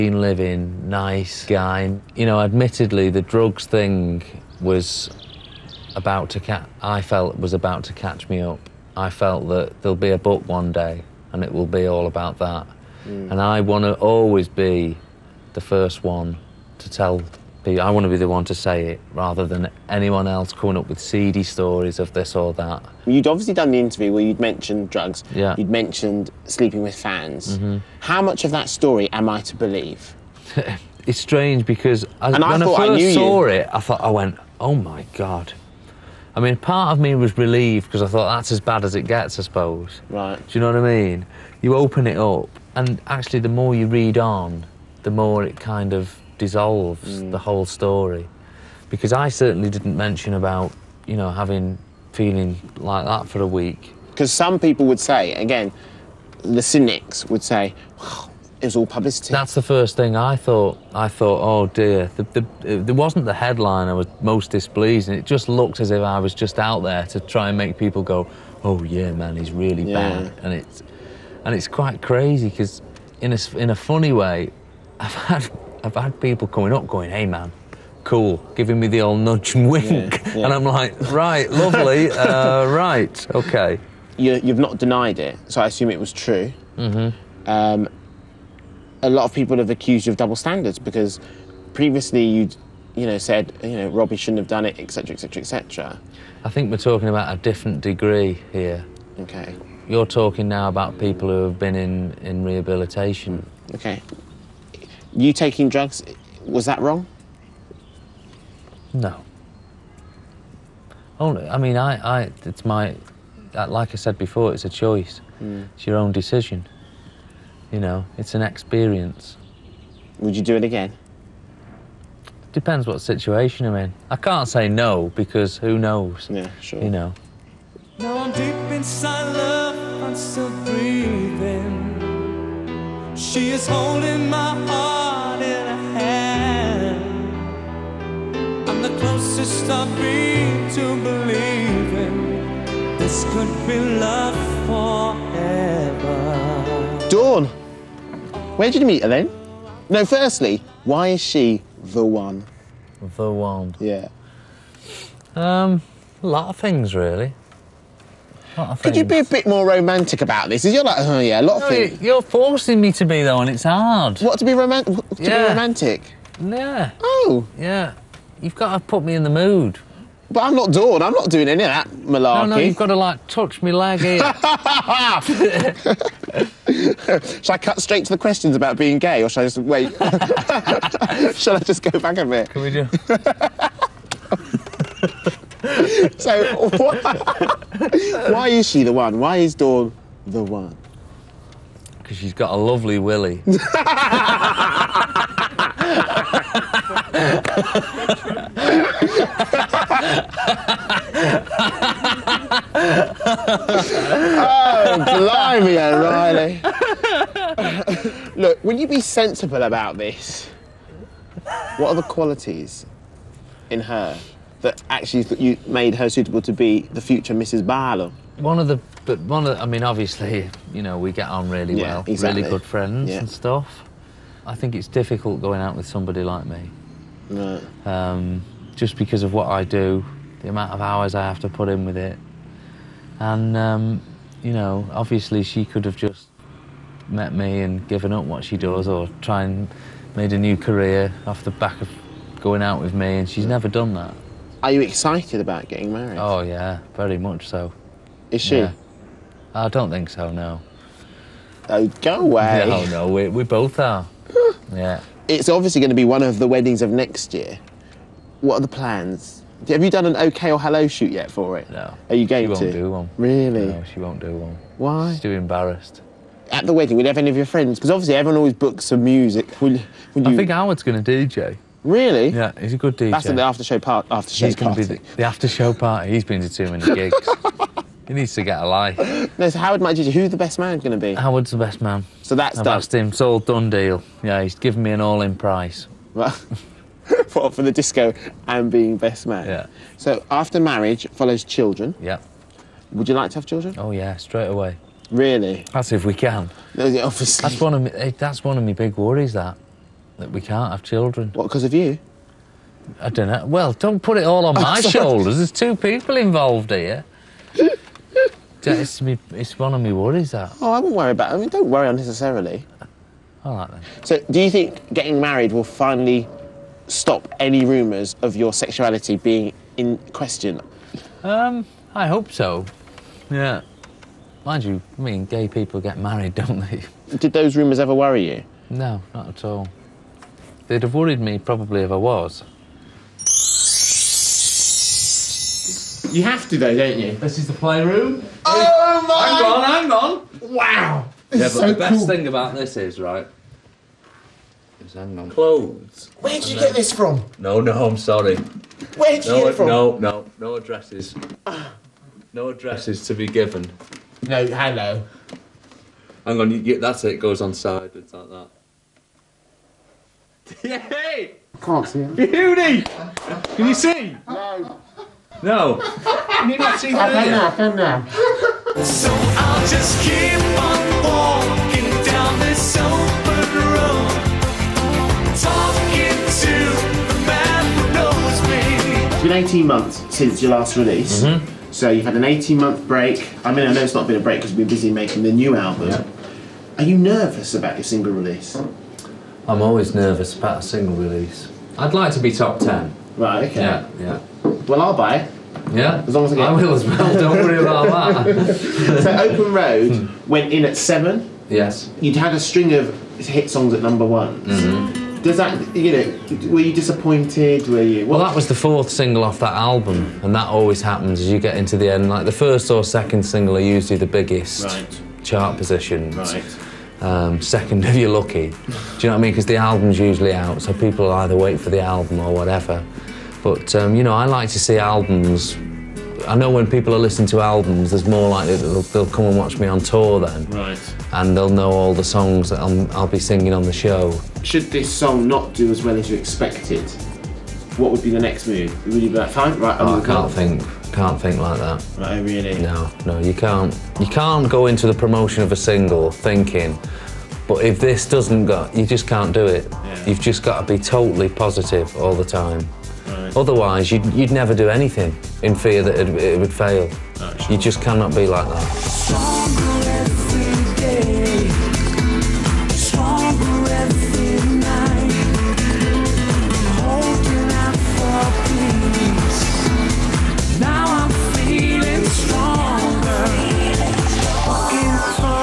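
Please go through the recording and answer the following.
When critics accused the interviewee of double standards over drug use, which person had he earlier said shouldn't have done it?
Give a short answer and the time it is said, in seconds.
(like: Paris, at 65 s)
Robbie, at 93 s.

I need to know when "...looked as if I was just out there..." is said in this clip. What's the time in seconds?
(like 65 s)
65 s.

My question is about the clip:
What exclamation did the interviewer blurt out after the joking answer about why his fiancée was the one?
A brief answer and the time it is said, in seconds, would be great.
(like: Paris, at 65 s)
Blimey, O'Reilly, at 205 s.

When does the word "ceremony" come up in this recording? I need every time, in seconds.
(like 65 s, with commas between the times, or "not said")
not said.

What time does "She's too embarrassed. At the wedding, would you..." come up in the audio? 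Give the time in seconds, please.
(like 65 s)
265 s.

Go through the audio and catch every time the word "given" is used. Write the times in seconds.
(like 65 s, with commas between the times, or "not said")
237 s, 284 s, 353 s.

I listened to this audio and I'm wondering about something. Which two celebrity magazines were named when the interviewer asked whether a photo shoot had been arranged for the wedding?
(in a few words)
OK or Hello.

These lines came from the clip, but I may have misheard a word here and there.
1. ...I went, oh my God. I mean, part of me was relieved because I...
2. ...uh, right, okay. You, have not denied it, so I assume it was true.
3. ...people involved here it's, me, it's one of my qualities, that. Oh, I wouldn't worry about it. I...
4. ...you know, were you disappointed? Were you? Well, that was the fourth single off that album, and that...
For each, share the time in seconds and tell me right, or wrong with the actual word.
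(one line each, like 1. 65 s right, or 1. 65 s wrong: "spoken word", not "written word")
1. 34 s right
2. 82 s right
3. 305 s wrong: "worries", not "qualities"
4. 405 s right.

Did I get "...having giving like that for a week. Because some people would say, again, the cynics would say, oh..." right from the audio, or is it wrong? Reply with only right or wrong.
wrong.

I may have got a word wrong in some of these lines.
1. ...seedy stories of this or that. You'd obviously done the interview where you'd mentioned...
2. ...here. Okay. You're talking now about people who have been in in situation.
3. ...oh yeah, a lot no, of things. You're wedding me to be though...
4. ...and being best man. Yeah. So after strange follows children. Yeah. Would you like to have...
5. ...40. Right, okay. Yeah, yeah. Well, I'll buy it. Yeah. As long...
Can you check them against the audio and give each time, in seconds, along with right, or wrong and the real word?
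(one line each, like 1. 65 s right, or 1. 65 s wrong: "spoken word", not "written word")
1. 20 s right
2. 98 s wrong: "rehabilitation", not "situation"
3. 160 s wrong: "forcing", not "wedding"
4. 288 s wrong: "marriage", not "strange"
5. 392 s wrong: "10", not "40".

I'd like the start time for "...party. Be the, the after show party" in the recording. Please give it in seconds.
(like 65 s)
274 s.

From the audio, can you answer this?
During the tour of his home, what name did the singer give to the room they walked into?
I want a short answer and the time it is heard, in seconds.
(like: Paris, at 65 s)
the playroom, at 337 s.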